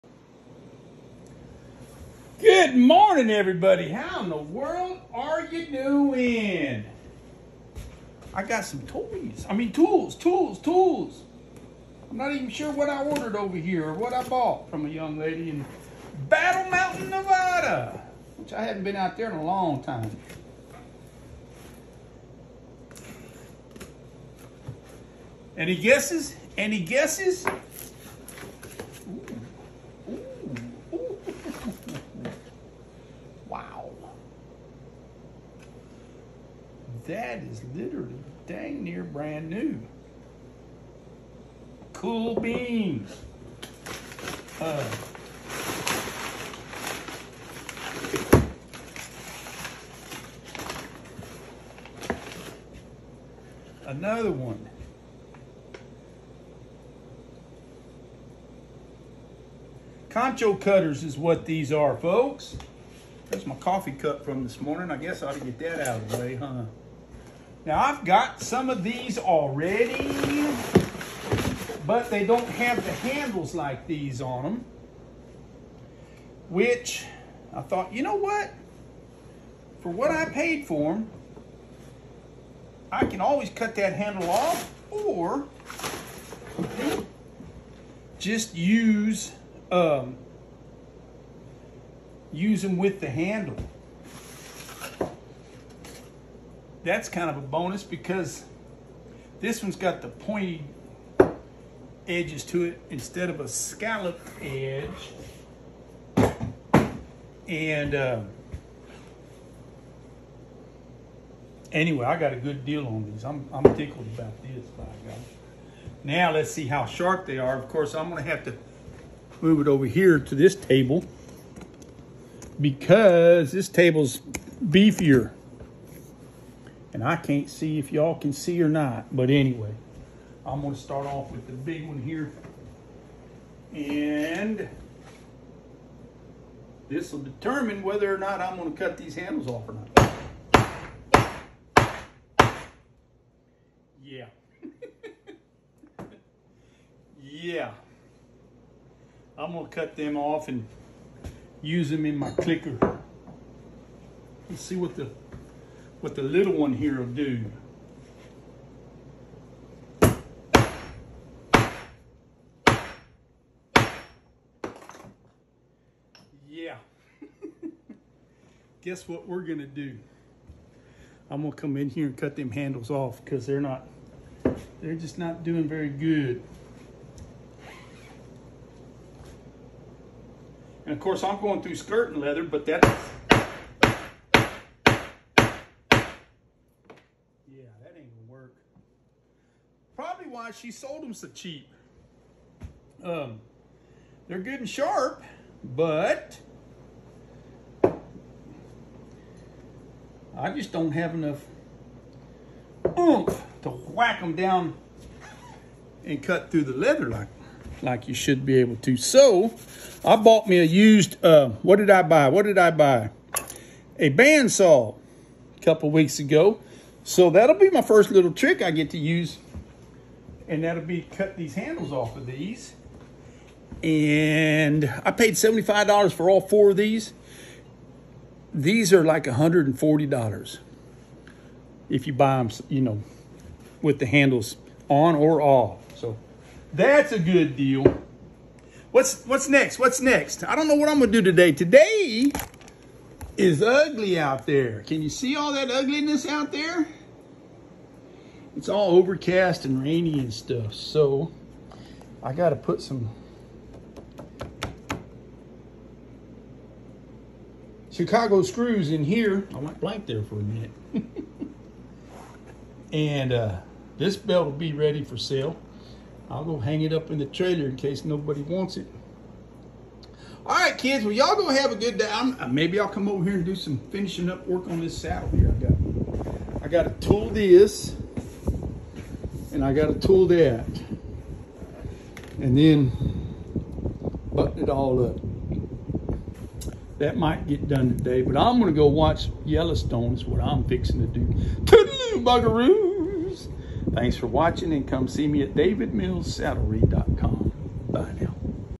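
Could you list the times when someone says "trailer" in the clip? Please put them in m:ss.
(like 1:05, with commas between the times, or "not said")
4:27.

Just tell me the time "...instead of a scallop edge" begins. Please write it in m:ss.
1:42.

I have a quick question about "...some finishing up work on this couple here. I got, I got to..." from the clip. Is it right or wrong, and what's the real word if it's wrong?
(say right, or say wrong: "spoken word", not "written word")
wrong: "saddle", not "couple".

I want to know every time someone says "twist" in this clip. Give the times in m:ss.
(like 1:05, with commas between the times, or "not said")
not said.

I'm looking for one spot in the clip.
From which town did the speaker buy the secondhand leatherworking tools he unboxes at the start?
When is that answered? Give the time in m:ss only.
0:16.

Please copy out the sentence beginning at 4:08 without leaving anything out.
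It's all overcast and rainy and stuff.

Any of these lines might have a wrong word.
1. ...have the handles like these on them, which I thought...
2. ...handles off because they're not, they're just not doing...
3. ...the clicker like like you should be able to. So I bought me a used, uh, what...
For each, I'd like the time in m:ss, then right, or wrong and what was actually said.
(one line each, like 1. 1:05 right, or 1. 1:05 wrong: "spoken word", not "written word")
1. 1:12 right
2. 2:52 right
3. 3:26 wrong: "leather", not "clicker".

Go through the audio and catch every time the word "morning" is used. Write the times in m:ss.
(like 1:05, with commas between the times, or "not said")
0:02, 1:04.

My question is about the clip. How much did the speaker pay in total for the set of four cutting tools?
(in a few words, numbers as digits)
$75.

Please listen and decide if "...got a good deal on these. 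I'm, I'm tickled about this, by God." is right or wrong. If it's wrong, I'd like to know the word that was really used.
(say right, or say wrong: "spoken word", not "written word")
right.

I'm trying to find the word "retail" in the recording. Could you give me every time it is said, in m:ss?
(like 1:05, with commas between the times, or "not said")
not said.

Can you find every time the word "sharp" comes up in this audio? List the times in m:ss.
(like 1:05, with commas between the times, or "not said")
1:56, 3:14.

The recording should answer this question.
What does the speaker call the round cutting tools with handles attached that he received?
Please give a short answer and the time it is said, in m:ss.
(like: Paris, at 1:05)
Concho cutters, at 1:00.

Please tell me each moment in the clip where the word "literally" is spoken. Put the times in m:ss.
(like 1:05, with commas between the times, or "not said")
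0:37.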